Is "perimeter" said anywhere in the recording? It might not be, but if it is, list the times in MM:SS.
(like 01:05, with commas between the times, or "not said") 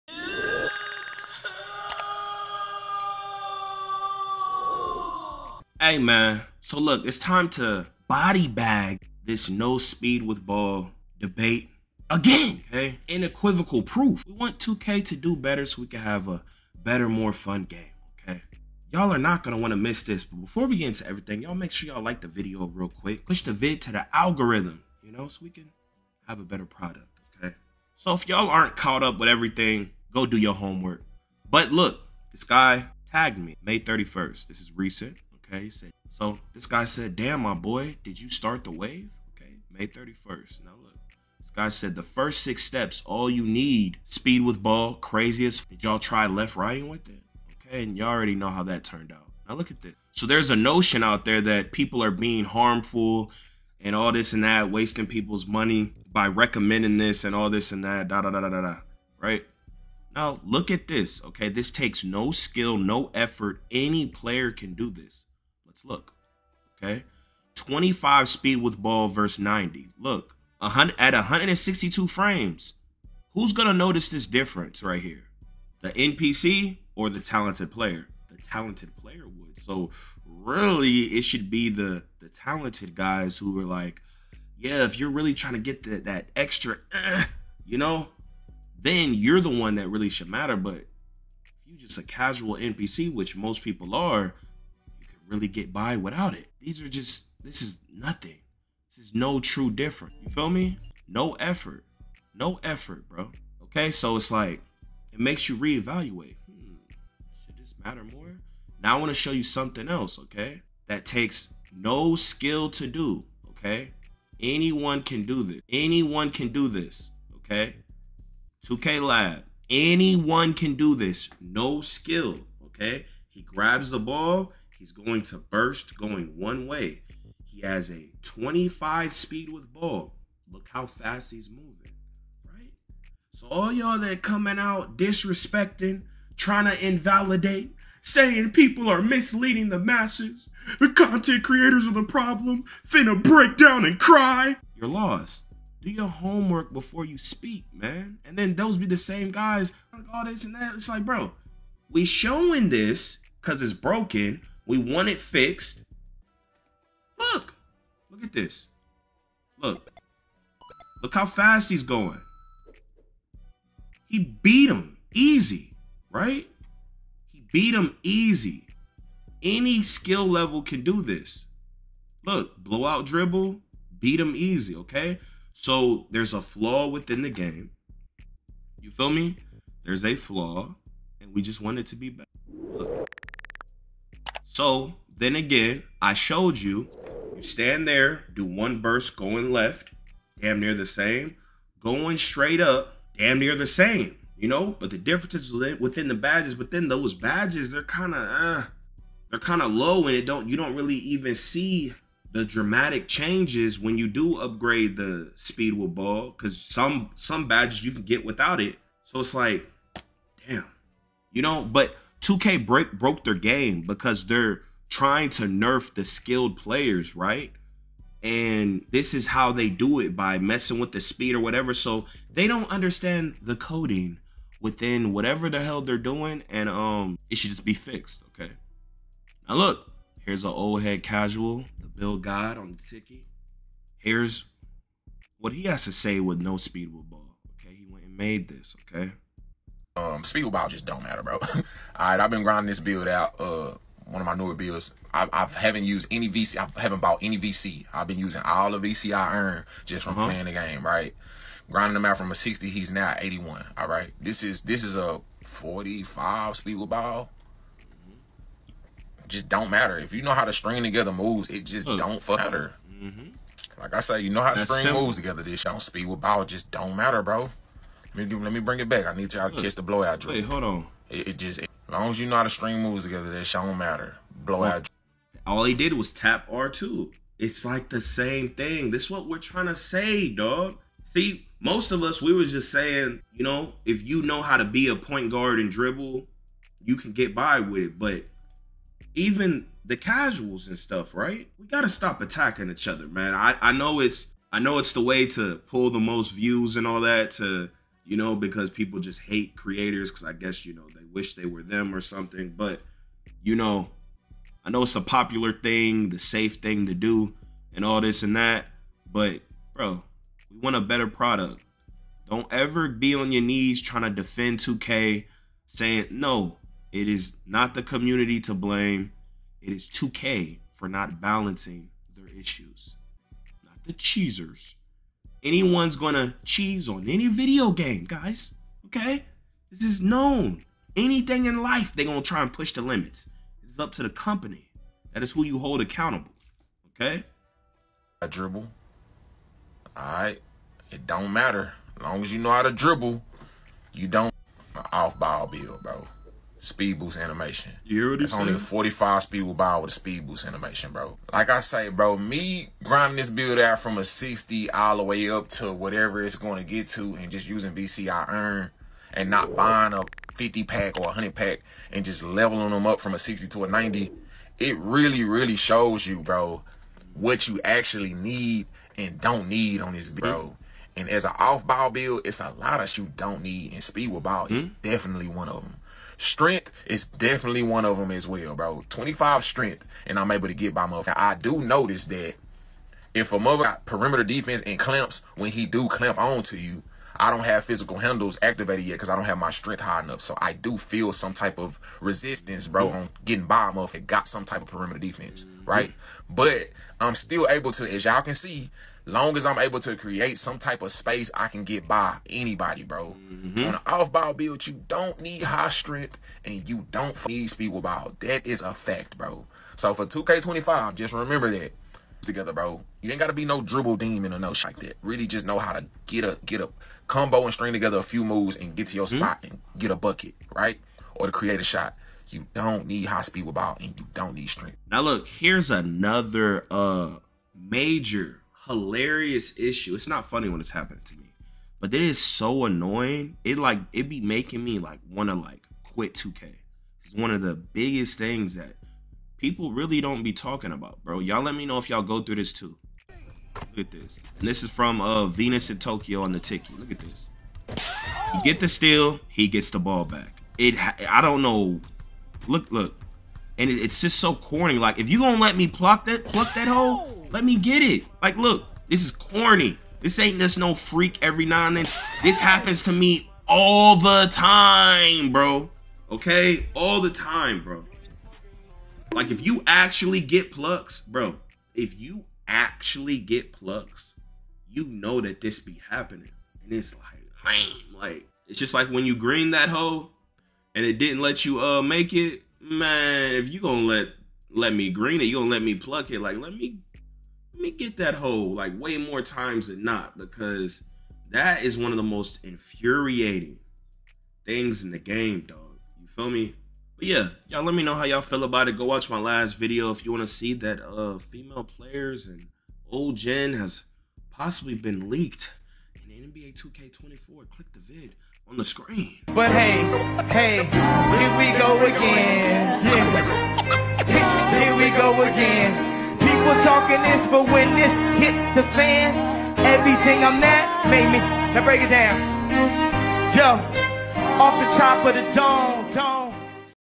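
06:23, 06:34.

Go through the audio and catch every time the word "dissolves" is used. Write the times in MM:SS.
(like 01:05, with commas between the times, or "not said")
not said.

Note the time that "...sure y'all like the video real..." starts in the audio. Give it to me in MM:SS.
00:21.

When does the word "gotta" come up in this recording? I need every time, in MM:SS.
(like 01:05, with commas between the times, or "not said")
04:51, 06:53.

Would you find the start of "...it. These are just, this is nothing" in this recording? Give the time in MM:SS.
01:36.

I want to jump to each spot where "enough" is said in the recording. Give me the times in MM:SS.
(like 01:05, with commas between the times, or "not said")
06:30.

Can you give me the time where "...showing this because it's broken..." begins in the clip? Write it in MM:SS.
02:32.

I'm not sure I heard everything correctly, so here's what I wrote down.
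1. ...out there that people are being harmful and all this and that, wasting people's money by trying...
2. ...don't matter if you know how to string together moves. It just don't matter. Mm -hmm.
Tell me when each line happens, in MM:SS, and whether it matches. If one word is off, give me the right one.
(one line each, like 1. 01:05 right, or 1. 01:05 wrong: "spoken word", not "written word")
1. 00:51 wrong: "recommending", not "trying"
2. 04:19 right.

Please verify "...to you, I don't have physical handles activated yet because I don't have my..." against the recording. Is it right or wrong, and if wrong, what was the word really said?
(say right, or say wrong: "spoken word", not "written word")
right.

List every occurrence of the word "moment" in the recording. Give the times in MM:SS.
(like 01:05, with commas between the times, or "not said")
not said.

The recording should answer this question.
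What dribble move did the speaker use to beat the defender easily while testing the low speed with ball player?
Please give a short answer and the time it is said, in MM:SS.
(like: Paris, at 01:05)
blowout dribble, at 02:52.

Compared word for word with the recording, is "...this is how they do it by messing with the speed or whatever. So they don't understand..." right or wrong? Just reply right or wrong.
right.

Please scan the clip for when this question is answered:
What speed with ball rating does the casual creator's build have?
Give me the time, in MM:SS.
04:15.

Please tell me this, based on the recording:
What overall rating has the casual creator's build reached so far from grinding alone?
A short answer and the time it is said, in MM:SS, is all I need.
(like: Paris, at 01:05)
81, at 04:12.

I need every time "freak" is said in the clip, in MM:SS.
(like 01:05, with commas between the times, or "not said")
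07:40.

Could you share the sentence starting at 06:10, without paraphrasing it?
And as an off ball build, it's a lot of you don't need, and speed with ball is mm -hmm.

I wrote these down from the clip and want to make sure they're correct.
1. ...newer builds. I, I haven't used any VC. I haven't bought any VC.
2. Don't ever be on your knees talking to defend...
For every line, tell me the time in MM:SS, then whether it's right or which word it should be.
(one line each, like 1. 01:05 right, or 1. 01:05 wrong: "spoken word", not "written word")
1. 04:04 right
2. 05:12 wrong: "trying", not "talking".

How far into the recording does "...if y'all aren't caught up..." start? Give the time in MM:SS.
00:28.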